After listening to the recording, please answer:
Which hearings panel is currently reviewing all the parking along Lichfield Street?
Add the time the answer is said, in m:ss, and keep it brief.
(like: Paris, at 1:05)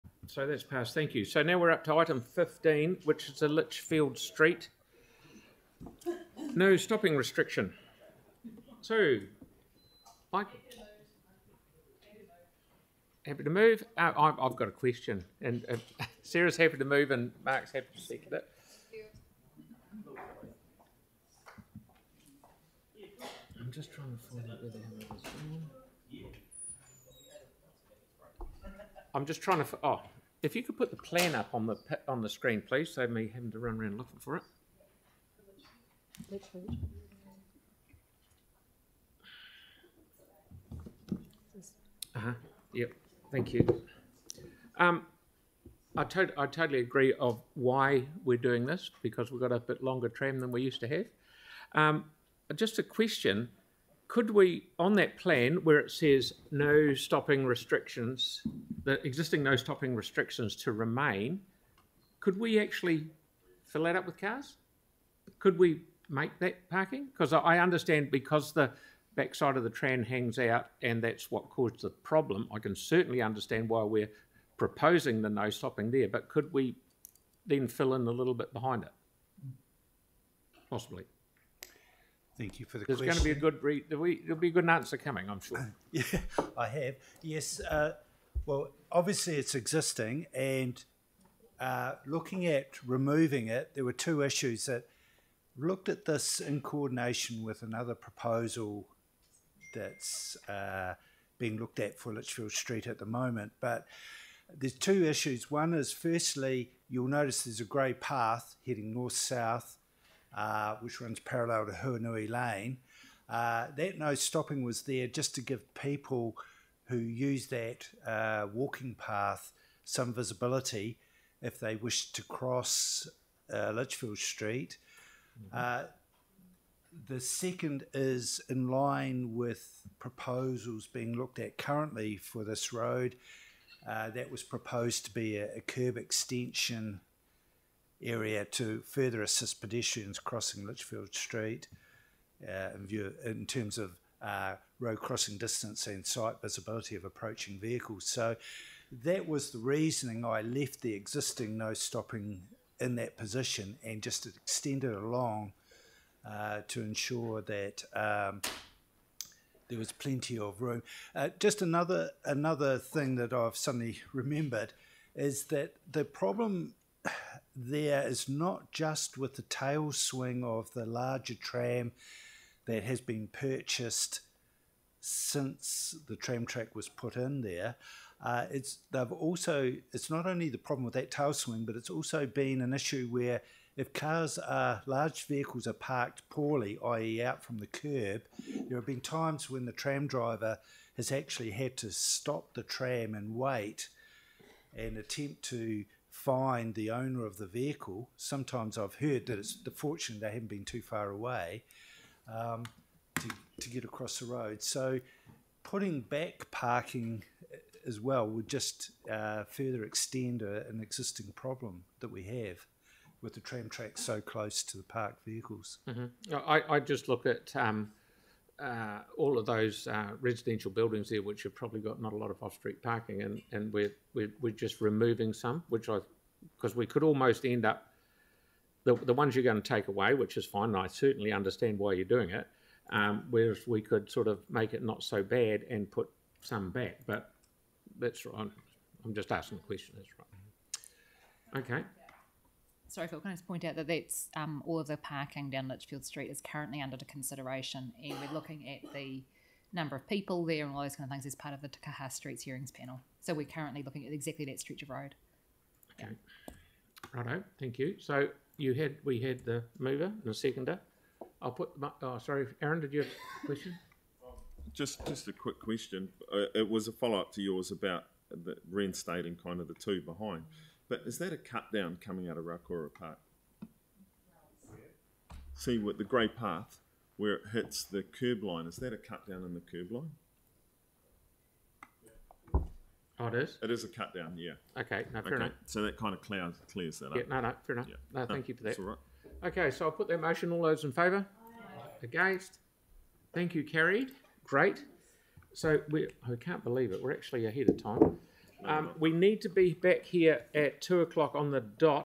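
Takaha Streets hearings panel, at 4:11.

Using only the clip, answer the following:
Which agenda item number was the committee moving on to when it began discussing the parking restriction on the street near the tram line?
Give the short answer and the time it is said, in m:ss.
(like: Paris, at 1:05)
15, at 0:01.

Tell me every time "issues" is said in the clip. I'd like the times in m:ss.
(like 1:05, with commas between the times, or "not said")
1:34, 1:45, 3:02.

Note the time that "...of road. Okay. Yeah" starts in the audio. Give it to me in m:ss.
4:14.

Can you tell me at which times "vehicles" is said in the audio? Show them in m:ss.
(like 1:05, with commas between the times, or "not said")
2:27, 3:05, 3:17, 3:35.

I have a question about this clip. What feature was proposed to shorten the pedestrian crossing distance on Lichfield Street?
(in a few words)
Curb extension.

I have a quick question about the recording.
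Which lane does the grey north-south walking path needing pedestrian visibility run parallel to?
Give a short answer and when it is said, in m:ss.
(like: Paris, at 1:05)
Huanui Lane, at 1:51.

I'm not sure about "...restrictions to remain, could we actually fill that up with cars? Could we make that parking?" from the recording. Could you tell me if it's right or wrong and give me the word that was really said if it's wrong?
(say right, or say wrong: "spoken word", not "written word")
right.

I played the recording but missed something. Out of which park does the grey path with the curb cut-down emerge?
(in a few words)
Rauora Park.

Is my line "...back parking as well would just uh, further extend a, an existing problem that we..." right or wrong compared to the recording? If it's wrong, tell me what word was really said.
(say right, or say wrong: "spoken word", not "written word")
right.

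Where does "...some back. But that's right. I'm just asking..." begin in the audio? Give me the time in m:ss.
3:56.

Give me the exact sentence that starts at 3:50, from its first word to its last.
And I certainly understand why you're doing it.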